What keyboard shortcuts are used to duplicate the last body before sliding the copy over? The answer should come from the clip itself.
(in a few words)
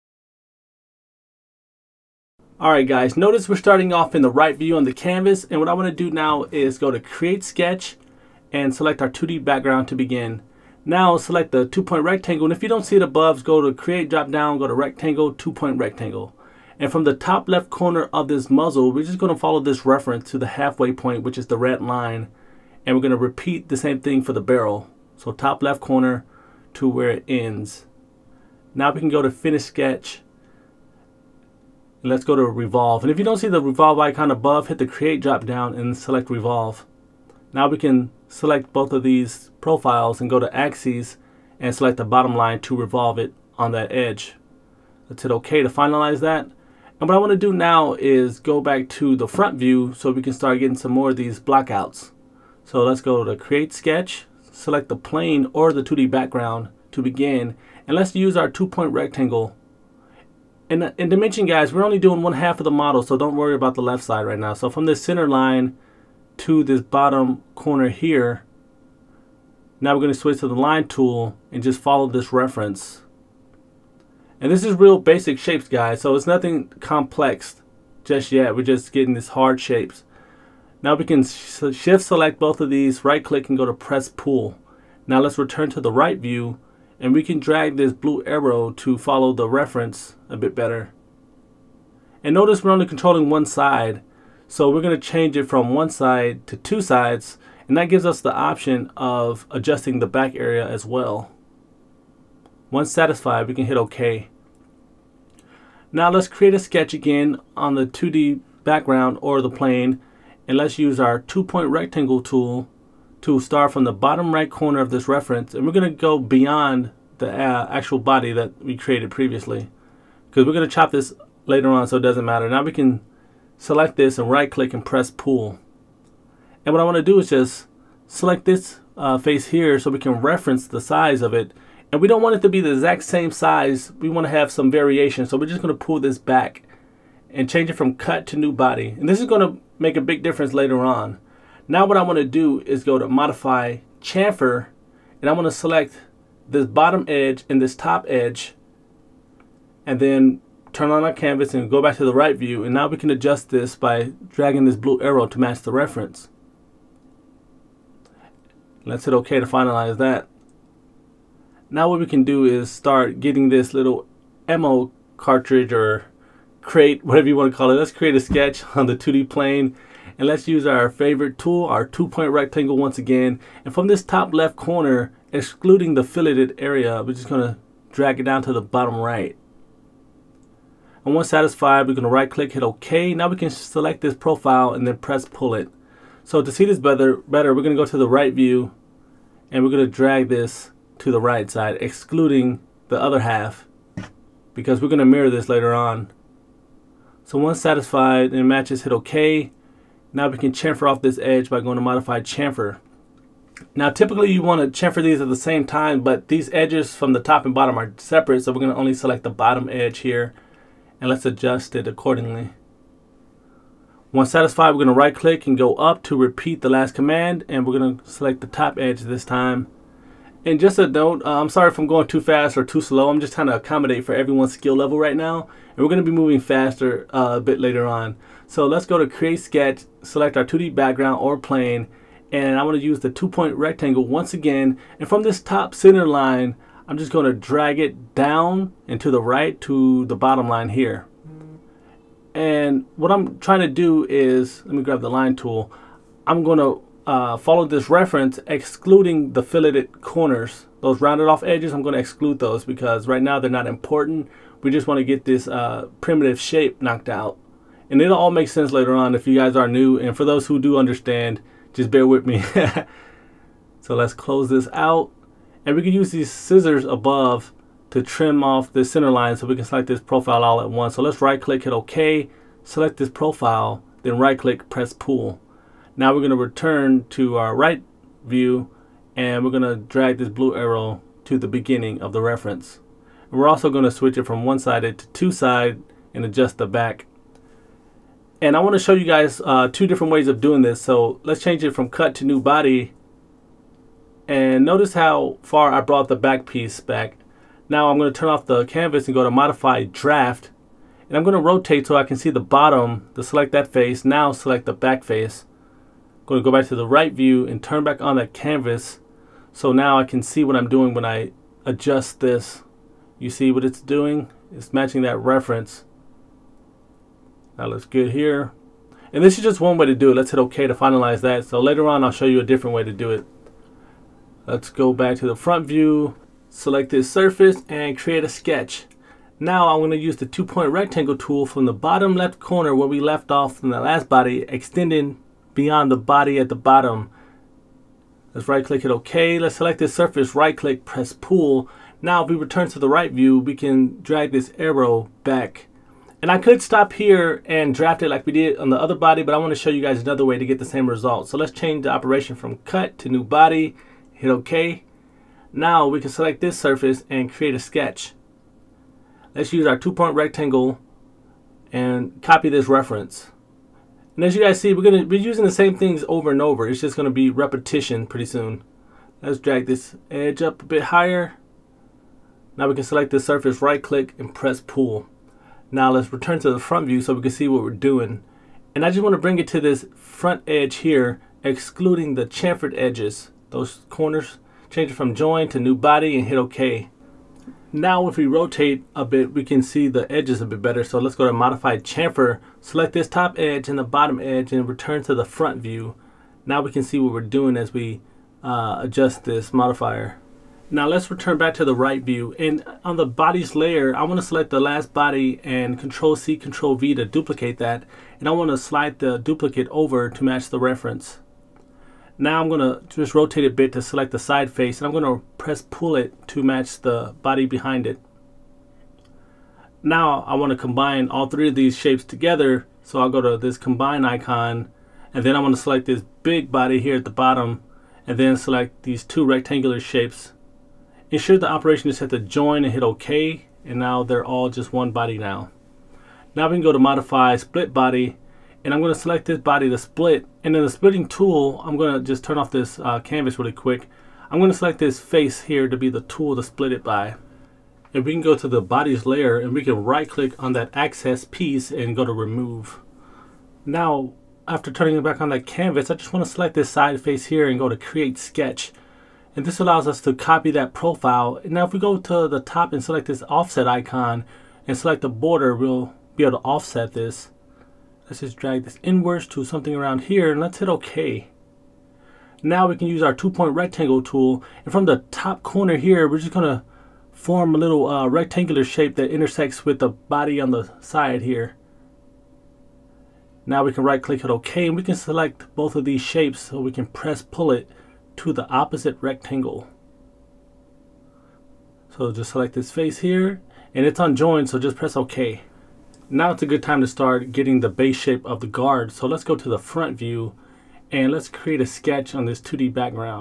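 Control C, Control V.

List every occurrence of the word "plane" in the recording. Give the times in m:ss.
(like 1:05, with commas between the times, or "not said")
0:54, 1:49, 2:49, 3:51.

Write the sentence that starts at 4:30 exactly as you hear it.
So let's right click, hit OK, select this profile, then right click, press pull.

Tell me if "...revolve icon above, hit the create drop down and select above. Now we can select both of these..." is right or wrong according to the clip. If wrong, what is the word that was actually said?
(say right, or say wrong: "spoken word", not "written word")
wrong: "revolve", not "above".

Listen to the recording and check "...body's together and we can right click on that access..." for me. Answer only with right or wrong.
wrong.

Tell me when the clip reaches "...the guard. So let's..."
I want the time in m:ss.
8:18.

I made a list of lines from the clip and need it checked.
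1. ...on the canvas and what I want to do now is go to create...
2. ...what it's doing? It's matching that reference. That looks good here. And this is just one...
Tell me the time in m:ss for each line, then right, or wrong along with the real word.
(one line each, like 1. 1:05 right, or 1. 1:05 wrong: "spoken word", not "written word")
1. 0:04 right
2. 5:13 right.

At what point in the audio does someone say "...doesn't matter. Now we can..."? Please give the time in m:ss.
2:02.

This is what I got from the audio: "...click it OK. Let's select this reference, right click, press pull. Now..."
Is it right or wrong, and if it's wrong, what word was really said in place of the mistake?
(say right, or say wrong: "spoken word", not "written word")
wrong: "surface", not "reference".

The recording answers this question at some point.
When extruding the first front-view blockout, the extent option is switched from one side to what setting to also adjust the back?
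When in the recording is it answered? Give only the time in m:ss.
1:36.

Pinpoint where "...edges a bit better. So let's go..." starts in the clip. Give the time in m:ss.
6:30.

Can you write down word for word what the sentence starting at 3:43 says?
I'm just trying to accommodate for everyone's skill level right now.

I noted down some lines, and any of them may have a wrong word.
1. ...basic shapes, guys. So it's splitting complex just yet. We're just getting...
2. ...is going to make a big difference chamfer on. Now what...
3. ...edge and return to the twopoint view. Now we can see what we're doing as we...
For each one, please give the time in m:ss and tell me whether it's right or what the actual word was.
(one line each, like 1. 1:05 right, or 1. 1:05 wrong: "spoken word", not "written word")
1. 1:14 wrong: "nothing", not "splitting"
2. 2:19 wrong: "later", not "chamfer"
3. 6:34 wrong: "front", not "twopoint".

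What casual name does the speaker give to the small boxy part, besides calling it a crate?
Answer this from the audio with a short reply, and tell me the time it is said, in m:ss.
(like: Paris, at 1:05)
ammo cartridge, at 2:44.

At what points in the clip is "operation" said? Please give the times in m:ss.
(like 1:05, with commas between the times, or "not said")
5:51, 7:11.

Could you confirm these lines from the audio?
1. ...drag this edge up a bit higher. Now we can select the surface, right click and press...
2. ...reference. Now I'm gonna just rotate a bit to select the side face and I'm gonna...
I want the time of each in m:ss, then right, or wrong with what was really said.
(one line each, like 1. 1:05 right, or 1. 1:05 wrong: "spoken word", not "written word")
1. 6:09 right
2. 6:50 right.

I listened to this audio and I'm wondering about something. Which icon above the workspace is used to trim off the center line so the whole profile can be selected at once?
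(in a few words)
scissors.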